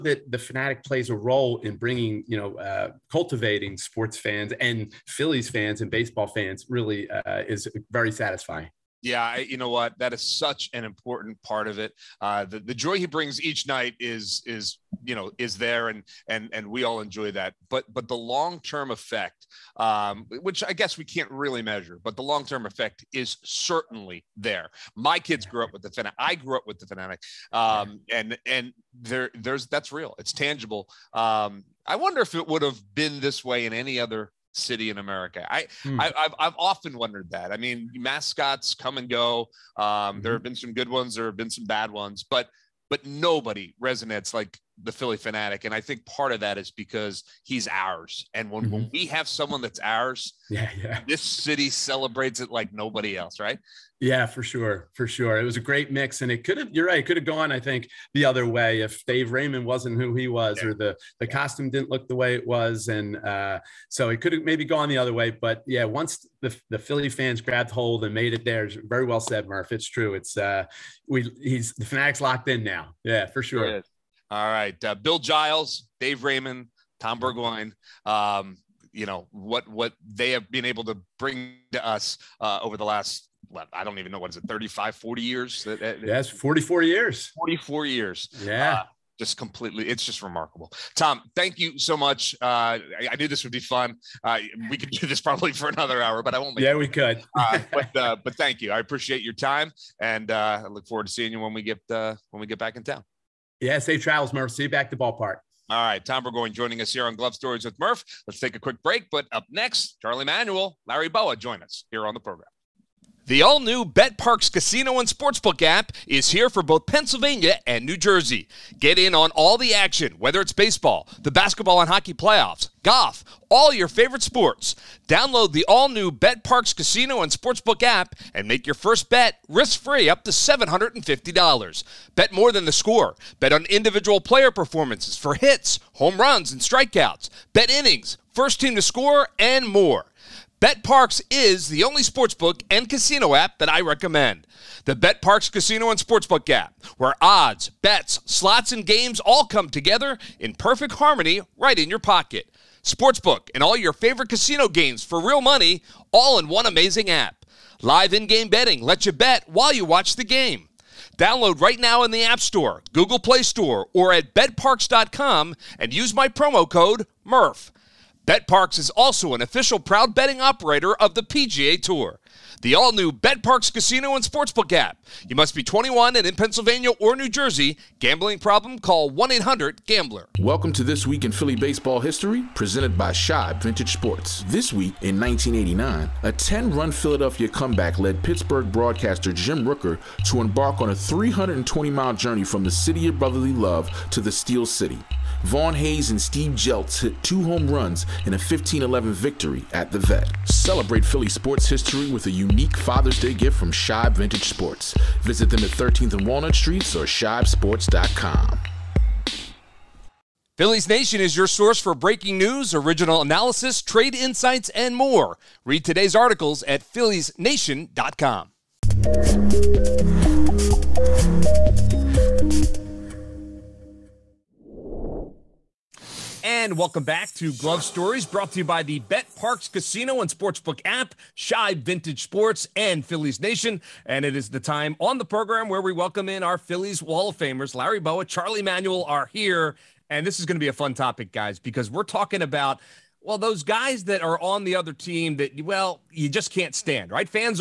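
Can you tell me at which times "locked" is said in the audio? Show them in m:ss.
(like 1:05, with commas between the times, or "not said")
1:12.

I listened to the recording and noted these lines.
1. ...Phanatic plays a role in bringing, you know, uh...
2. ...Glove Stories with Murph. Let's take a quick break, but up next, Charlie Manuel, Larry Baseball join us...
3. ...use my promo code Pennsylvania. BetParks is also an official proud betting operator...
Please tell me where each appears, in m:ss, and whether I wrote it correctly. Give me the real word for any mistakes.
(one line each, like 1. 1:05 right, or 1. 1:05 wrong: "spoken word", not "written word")
1. 0:00 right
2. 1:47 wrong: "Bowa", not "Baseball"
3. 2:45 wrong: "MURF", not "Pennsylvania".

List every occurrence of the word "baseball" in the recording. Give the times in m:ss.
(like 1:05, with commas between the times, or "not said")
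0:05, 2:00, 3:01.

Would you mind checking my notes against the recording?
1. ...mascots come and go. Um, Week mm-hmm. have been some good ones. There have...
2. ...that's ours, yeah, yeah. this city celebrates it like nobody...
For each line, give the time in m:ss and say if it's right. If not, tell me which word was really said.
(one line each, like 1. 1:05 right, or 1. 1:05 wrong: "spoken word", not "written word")
1. 0:37 wrong: "There", not "Week"
2. 0:49 right.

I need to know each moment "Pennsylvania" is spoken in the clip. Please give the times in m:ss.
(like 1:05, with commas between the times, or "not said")
1:56, 2:56.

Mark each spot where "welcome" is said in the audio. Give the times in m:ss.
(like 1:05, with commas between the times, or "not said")
3:00, 3:46, 3:55.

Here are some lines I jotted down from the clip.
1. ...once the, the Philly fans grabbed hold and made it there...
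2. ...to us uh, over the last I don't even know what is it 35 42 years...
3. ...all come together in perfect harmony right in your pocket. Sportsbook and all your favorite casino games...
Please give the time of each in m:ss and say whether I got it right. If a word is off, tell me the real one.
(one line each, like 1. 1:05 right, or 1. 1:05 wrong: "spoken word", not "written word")
1. 1:05 right
2. 1:21 wrong: "40", not "42"
3. 2:29 right.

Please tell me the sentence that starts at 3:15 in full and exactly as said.
Von Hayes and Steve Jeltz hit two home runs in a 15-11 victory at the Vet.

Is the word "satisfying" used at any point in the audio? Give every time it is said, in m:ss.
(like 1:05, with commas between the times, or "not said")
0:08.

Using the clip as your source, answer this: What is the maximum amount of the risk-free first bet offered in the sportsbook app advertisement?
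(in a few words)
$750.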